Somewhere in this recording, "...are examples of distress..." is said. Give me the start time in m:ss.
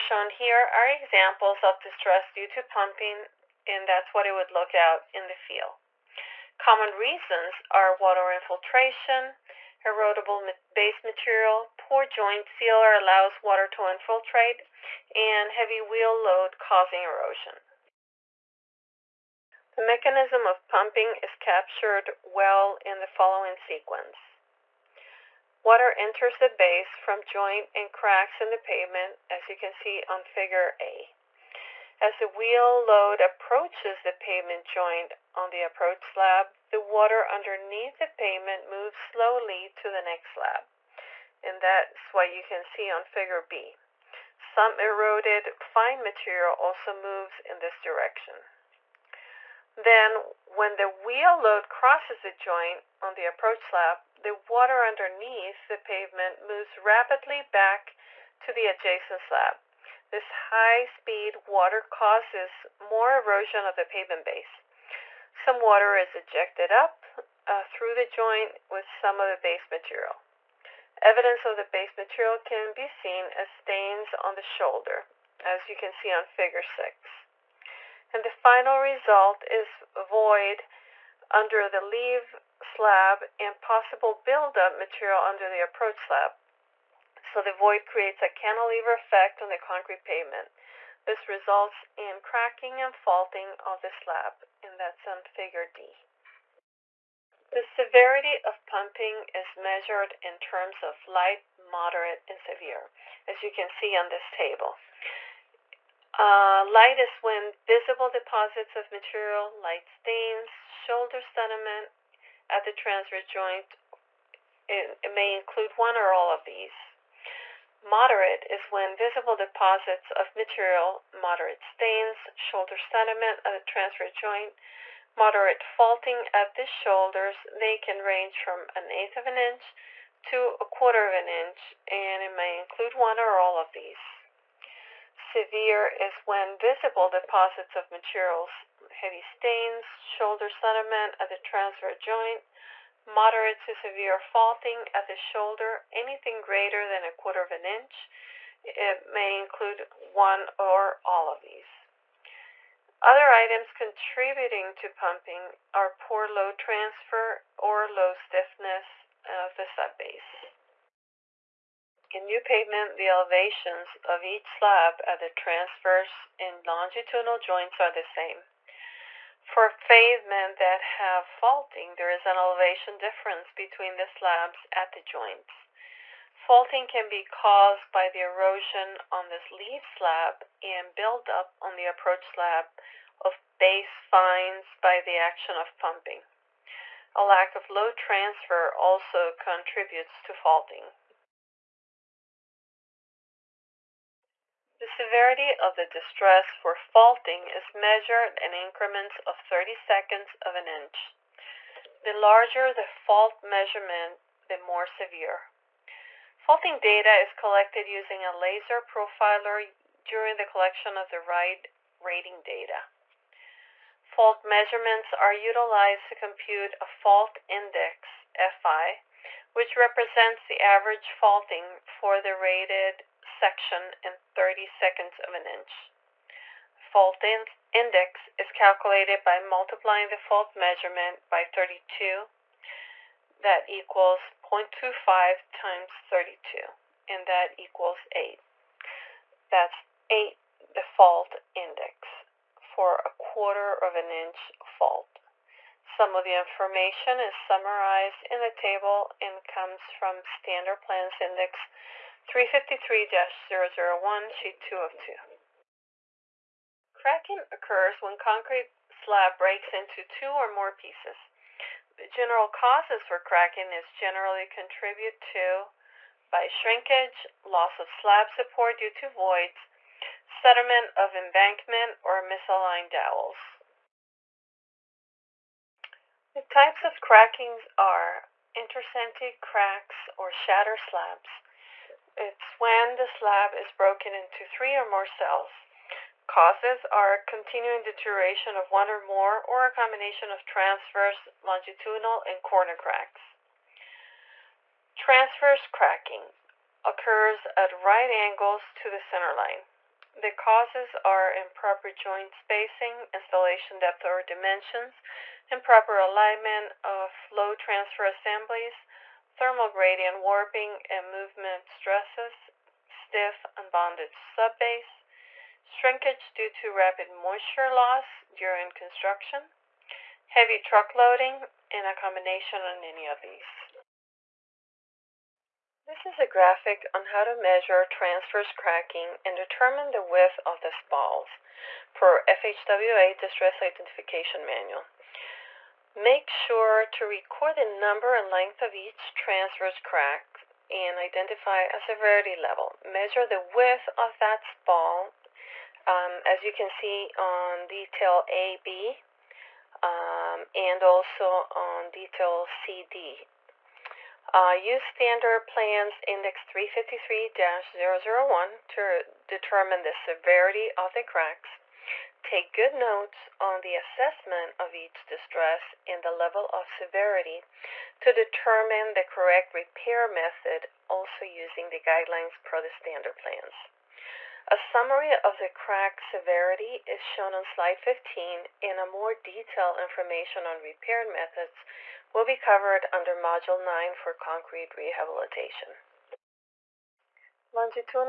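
0:00.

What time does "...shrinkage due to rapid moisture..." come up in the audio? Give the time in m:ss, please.
5:15.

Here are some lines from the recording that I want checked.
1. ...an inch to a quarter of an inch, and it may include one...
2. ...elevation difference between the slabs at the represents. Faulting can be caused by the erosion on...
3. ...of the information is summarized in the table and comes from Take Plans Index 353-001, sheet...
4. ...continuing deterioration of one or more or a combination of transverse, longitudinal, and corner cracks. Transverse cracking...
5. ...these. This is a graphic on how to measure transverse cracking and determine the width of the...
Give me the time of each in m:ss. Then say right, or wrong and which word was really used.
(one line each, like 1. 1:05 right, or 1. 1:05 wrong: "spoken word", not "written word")
1. 2:09 right
2. 2:52 wrong: "joints", not "represents"
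3. 4:06 wrong: "Standard", not "Take"
4. 4:47 right
5. 5:23 right.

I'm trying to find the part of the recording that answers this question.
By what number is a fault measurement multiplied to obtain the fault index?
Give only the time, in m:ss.
3:49.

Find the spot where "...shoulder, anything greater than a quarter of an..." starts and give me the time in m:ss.
2:25.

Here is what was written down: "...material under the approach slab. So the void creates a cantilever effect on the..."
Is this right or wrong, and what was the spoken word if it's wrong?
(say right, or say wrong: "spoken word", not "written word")
right.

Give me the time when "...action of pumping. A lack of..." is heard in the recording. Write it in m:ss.
3:05.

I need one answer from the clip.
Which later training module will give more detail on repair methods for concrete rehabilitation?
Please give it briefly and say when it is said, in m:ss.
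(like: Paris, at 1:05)
Module 9, at 6:23.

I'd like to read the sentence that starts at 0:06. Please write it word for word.
Common reasons are water infiltration, erodible base material, poor joint sealer allows water to infiltrate, and heavy wheel load causing erosion.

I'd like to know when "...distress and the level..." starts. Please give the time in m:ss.
6:05.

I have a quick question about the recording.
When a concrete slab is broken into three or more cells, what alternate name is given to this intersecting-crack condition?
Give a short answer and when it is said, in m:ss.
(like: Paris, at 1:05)
shatter slabs, at 4:40.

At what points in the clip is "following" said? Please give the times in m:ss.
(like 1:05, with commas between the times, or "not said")
0:23.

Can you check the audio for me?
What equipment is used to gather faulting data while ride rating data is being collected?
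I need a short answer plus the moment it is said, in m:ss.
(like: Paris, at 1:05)
laser profiler, at 3:28.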